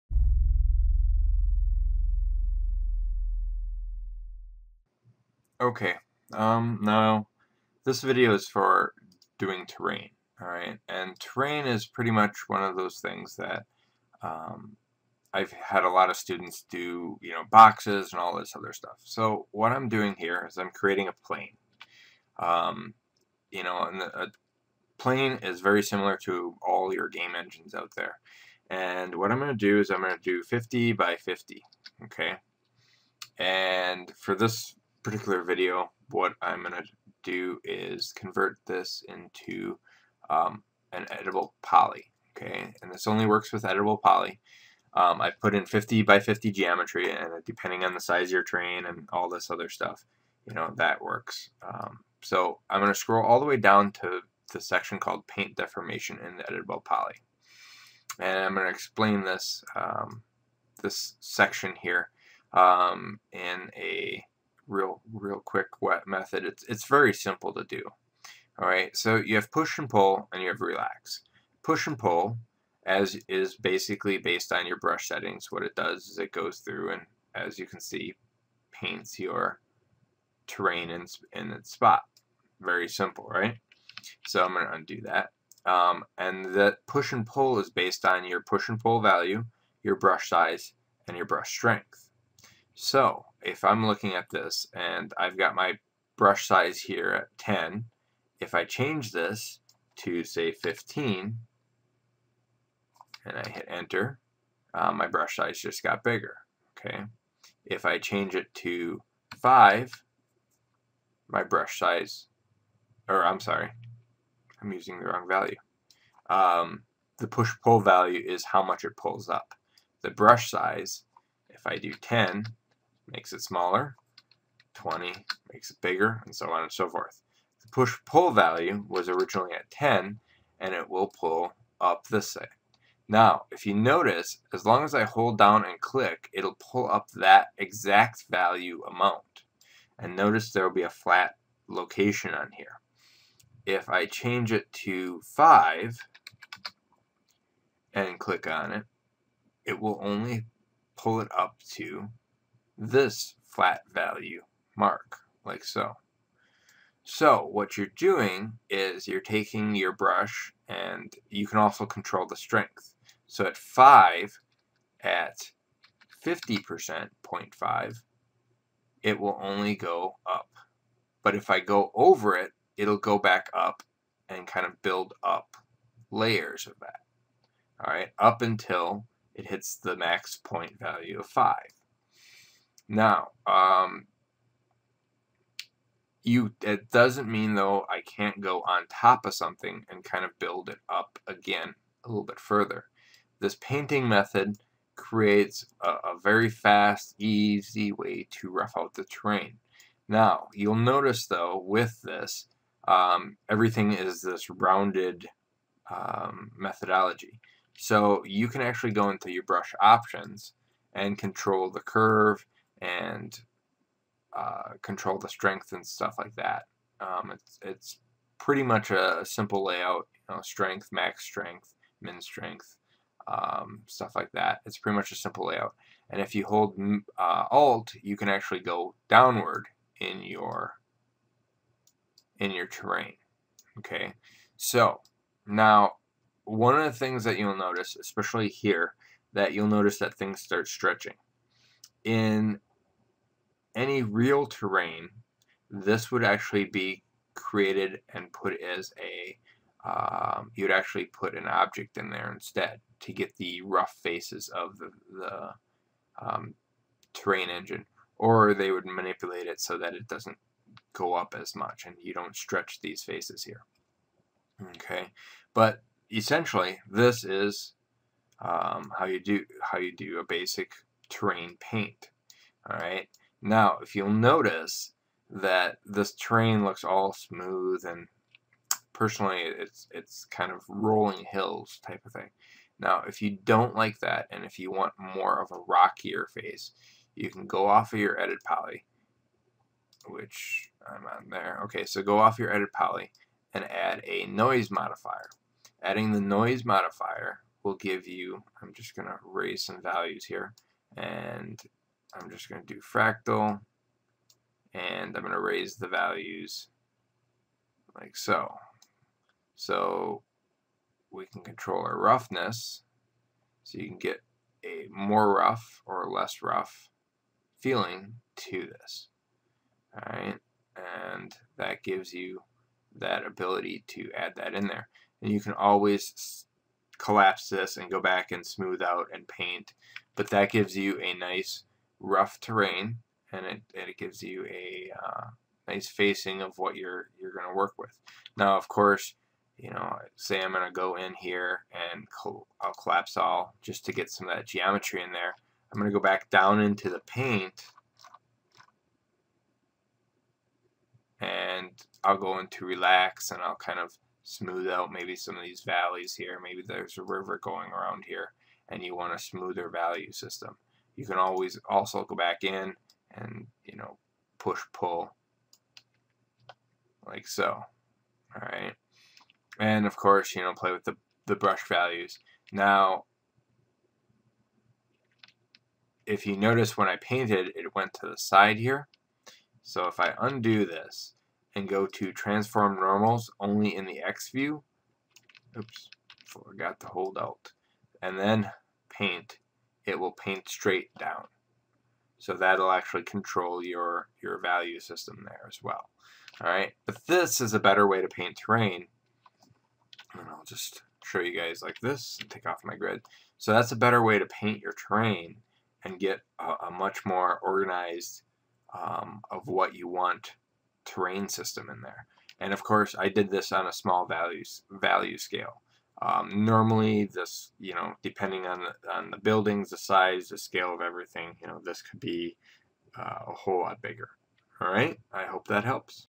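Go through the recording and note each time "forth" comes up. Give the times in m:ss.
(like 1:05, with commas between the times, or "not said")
2:06.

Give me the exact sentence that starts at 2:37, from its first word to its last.
So what you're doing is you're taking your brush and you can also control the strength.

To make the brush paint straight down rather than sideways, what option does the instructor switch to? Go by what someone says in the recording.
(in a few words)
transform normals only.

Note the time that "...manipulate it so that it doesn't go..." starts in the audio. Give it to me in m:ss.
4:18.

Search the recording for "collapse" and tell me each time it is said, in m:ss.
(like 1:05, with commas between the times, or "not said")
5:26, 5:42.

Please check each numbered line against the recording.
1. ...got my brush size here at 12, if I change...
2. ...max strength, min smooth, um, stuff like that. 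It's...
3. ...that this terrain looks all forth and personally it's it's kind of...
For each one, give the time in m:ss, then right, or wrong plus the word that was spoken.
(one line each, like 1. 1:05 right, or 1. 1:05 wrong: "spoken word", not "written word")
1. 1:35 wrong: "10", not "12"
2. 3:40 wrong: "strength", not "smooth"
3. 4:35 wrong: "smooth", not "forth".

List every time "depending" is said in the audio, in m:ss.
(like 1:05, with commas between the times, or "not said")
0:47, 6:58.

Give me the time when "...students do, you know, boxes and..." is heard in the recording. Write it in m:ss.
0:16.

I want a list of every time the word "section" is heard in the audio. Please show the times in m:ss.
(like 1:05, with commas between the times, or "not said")
0:54, 1:01.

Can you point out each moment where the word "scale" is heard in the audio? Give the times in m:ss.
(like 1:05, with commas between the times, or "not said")
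6:55, 7:00.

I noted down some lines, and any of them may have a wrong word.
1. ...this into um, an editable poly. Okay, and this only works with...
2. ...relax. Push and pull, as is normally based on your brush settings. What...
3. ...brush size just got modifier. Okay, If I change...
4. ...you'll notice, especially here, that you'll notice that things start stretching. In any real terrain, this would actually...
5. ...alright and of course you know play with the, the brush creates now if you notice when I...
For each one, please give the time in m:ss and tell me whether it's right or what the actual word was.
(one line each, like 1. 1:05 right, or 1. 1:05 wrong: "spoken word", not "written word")
1. 0:38 right
2. 1:10 wrong: "basically", not "normally"
3. 1:45 wrong: "bigger", not "modifier"
4. 3:57 right
5. 6:08 wrong: "values", not "creates".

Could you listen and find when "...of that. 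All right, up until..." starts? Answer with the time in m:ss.
2:56.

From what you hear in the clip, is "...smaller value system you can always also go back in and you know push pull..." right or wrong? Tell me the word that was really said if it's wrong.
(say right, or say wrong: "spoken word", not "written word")
wrong: "smoother", not "smaller".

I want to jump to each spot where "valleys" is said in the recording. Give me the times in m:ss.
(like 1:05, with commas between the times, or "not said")
5:55.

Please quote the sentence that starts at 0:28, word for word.
And what I'm going to do is I'm going to do 50 by 50, okay?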